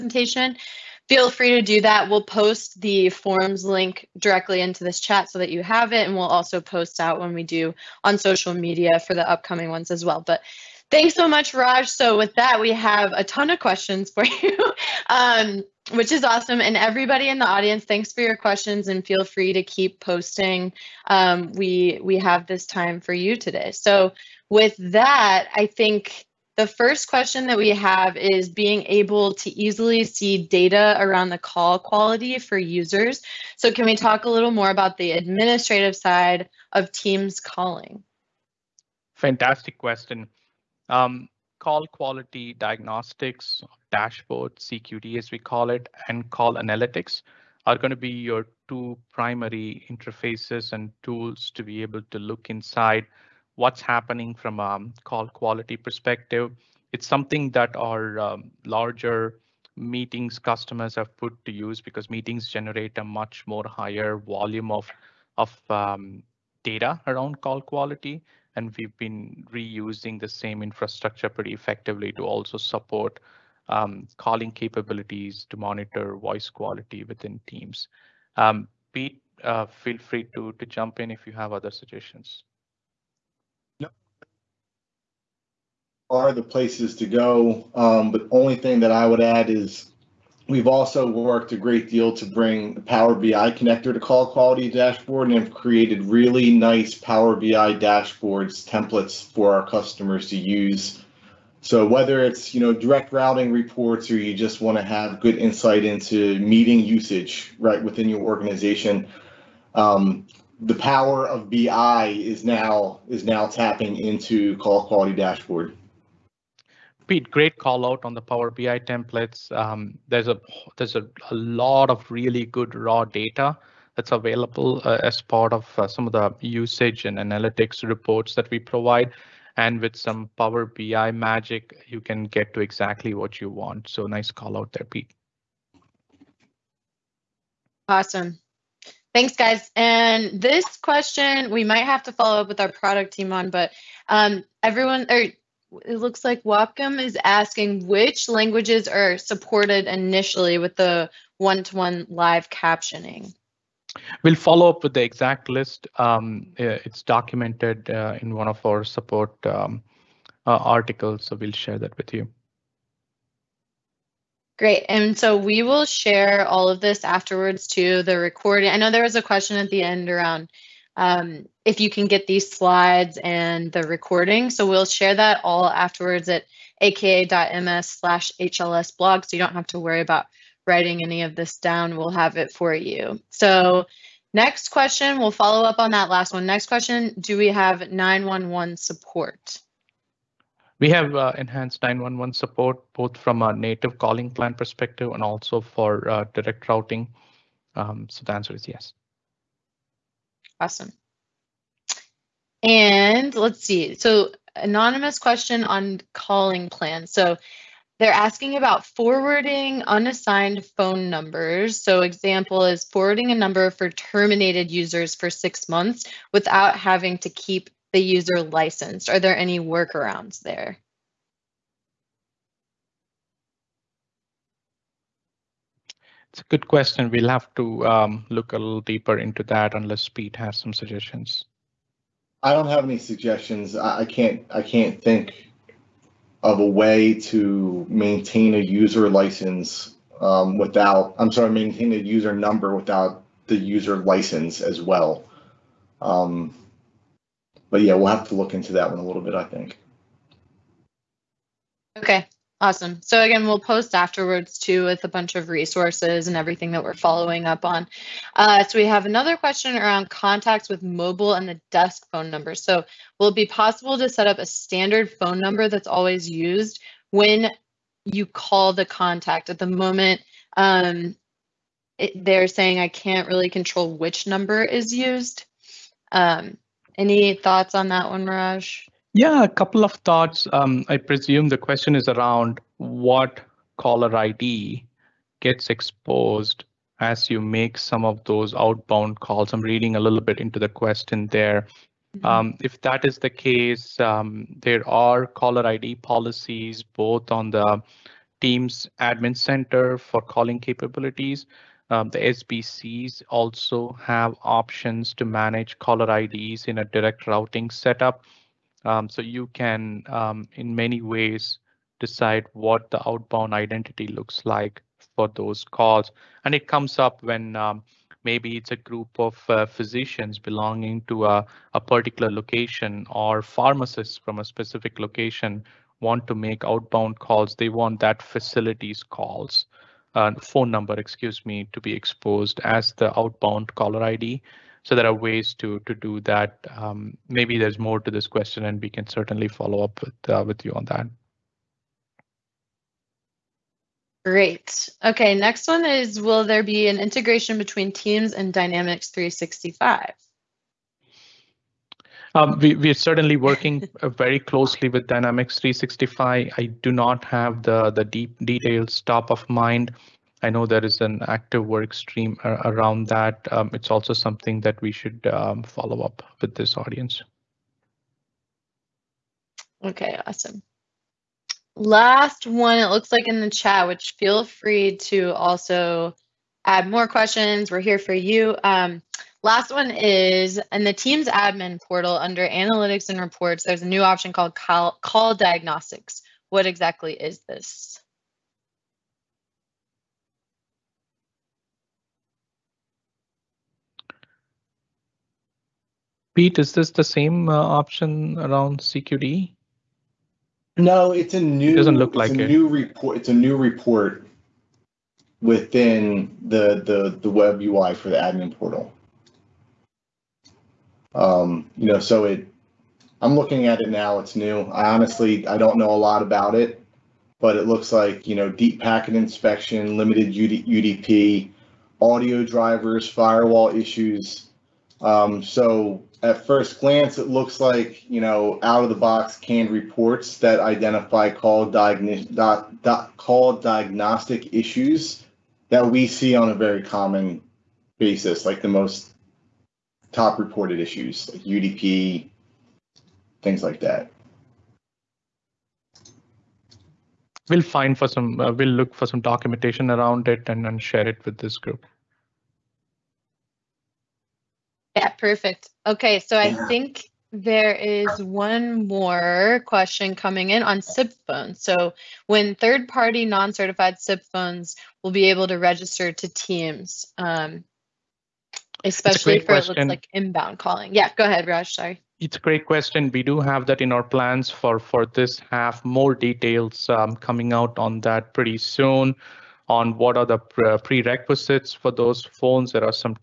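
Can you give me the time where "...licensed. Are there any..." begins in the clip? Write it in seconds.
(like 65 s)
218 s.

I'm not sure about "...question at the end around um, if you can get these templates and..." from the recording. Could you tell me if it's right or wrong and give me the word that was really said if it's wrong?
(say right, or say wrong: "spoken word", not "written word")
wrong: "slides", not "templates".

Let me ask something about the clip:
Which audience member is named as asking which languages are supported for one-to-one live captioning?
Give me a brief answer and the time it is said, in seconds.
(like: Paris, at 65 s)
Wapcom, at 146 s.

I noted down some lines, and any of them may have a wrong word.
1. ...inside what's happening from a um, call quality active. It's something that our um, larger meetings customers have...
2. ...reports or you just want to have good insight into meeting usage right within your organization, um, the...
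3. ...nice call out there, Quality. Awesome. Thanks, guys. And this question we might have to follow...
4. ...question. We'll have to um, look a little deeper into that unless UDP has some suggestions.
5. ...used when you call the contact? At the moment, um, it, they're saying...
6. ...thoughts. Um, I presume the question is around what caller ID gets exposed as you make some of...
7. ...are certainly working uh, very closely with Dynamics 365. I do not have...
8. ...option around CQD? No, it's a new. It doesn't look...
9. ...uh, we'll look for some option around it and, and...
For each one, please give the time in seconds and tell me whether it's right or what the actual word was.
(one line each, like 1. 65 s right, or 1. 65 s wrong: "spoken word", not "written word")
1. 52 s wrong: "perspective", not "active"
2. 103 s right
3. 134 s wrong: "Pete", not "Quality"
4. 226 s wrong: "Pete", not "UDP"
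5. 266 s right
6. 279 s right
7. 352 s right
8. 397 s right
9. 448 s wrong: "documentation", not "option".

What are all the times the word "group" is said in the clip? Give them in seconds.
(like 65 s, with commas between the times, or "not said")
318 s, 451 s.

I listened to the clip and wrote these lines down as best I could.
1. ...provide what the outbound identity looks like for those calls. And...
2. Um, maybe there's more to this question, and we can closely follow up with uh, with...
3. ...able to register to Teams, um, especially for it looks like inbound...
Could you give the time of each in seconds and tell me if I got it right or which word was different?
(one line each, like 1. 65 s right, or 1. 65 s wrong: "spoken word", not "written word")
1. 312 s wrong: "decide", not "provide"
2. 336 s wrong: "certainly", not "closely"
3. 465 s right.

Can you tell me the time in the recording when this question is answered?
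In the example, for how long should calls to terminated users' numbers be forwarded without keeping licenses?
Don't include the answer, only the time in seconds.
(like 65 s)
215 s.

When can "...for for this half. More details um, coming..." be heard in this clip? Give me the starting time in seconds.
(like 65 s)
474 s.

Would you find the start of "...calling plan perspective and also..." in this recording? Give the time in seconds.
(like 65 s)
193 s.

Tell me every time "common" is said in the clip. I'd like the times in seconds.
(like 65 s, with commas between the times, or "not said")
436 s.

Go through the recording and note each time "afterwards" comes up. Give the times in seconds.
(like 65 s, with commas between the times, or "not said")
167 s, 175 s, 253 s.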